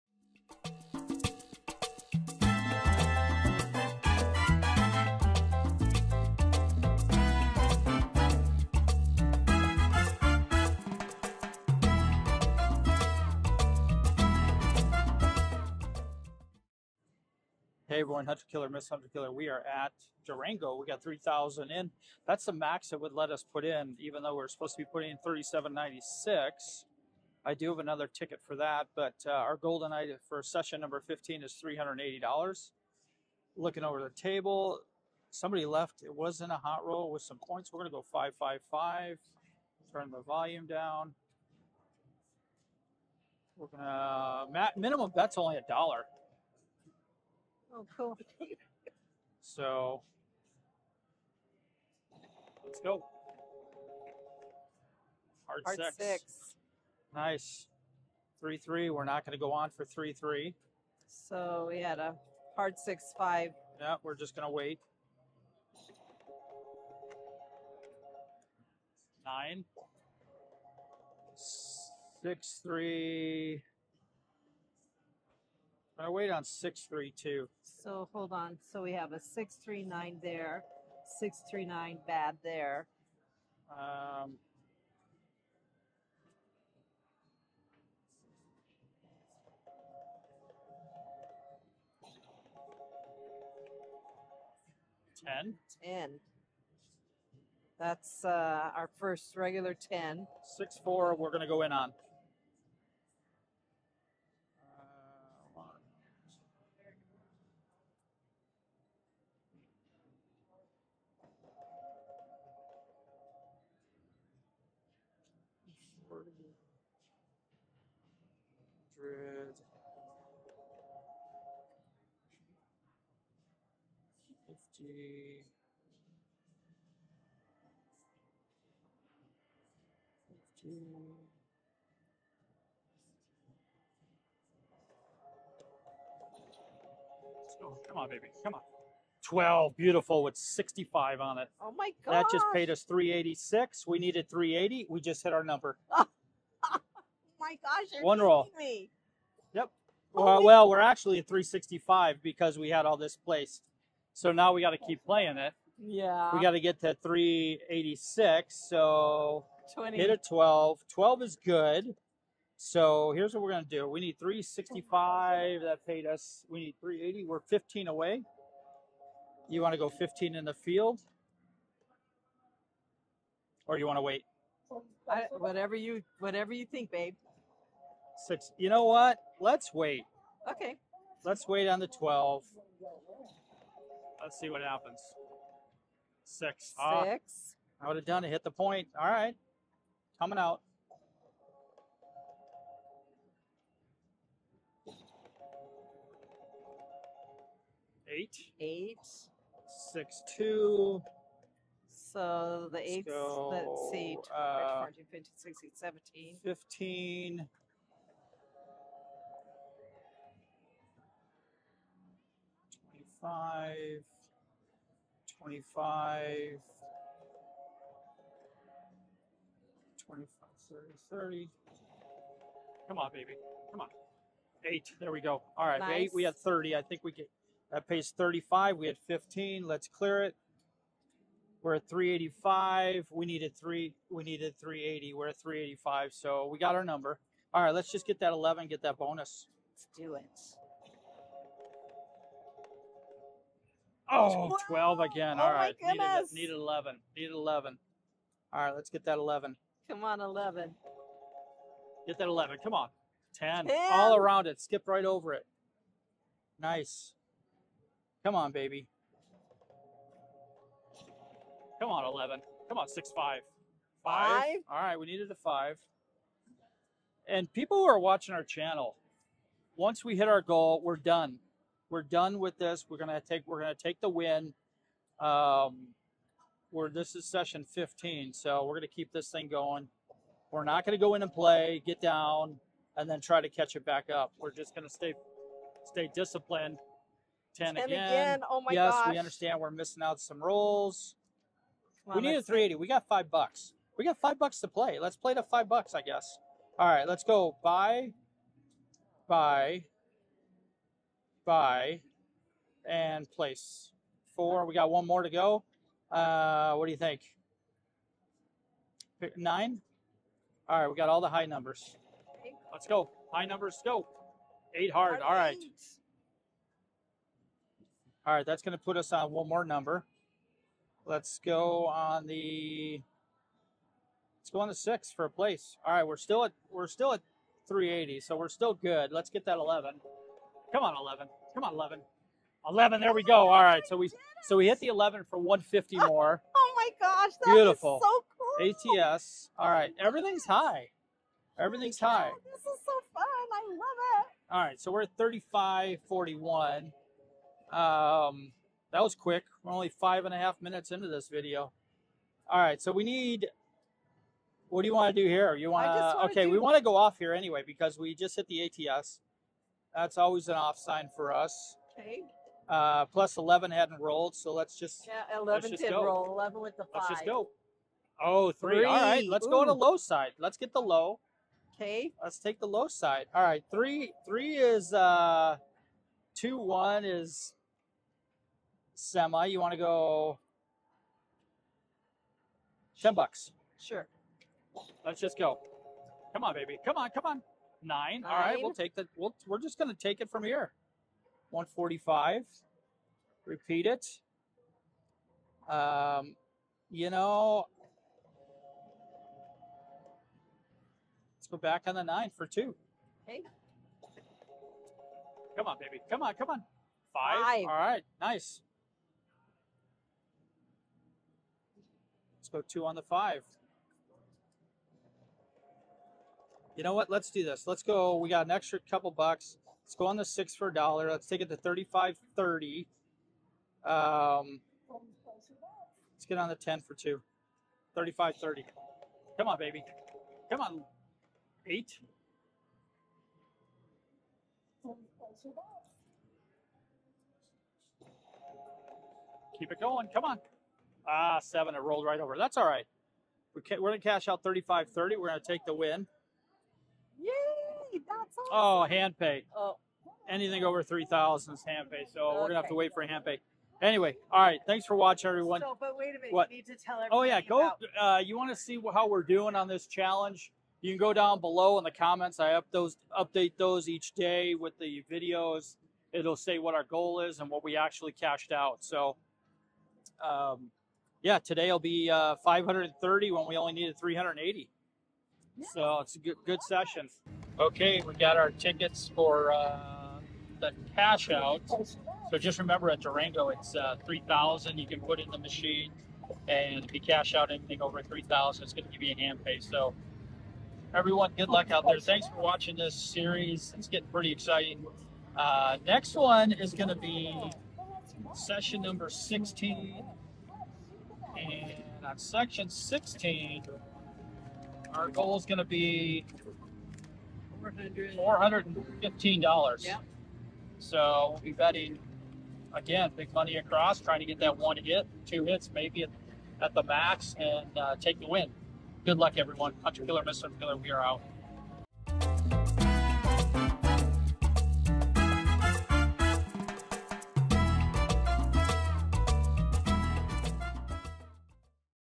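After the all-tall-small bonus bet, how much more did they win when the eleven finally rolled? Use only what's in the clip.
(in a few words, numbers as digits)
150.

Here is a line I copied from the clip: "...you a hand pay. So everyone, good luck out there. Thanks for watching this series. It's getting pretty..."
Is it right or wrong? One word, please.
right.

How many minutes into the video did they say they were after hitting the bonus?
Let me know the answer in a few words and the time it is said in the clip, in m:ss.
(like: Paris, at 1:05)
five and a half, at 5:49.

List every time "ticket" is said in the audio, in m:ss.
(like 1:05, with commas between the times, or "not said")
0:28, 7:58.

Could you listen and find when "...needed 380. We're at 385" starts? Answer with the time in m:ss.
3:54.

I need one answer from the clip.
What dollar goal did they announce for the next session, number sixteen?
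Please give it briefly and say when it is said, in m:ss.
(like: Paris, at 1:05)
$415, at 8:27.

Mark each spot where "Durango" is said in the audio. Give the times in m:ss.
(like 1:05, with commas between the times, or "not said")
0:20, 8:03.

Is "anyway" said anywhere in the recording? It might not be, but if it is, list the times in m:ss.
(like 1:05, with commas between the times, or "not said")
5:57, 7:33.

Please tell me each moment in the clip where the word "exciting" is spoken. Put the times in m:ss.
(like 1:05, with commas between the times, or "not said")
8:14.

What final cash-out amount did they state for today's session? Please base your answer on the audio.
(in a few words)
530.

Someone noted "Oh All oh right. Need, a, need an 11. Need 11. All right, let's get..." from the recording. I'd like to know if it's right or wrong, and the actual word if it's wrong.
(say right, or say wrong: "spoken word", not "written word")
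right.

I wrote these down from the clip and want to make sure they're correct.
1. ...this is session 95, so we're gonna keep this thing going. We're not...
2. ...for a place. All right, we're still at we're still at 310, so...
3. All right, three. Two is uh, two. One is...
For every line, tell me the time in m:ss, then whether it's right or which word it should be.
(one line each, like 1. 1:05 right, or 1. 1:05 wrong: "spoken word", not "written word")
1. 4:36 wrong: "15", not "95"
2. 5:25 wrong: "380", not "310"
3. 6:13 wrong: "Three", not "Two".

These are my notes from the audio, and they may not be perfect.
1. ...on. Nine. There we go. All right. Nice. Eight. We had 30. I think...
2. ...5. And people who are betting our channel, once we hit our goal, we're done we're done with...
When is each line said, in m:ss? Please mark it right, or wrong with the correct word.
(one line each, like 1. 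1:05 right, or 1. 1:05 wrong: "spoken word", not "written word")
1. 3:43 wrong: "Eight", not "Nine"
2. 4:25 wrong: "watching", not "betting".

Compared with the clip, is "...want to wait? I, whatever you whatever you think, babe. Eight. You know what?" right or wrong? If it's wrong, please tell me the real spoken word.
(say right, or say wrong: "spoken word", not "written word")
wrong: "Six", not "Eight".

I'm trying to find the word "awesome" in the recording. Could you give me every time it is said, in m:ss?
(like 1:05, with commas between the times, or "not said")
7:28.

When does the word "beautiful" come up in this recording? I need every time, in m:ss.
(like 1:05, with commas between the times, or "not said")
2:19, 5:37.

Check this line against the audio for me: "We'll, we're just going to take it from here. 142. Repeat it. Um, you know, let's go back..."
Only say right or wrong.
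wrong.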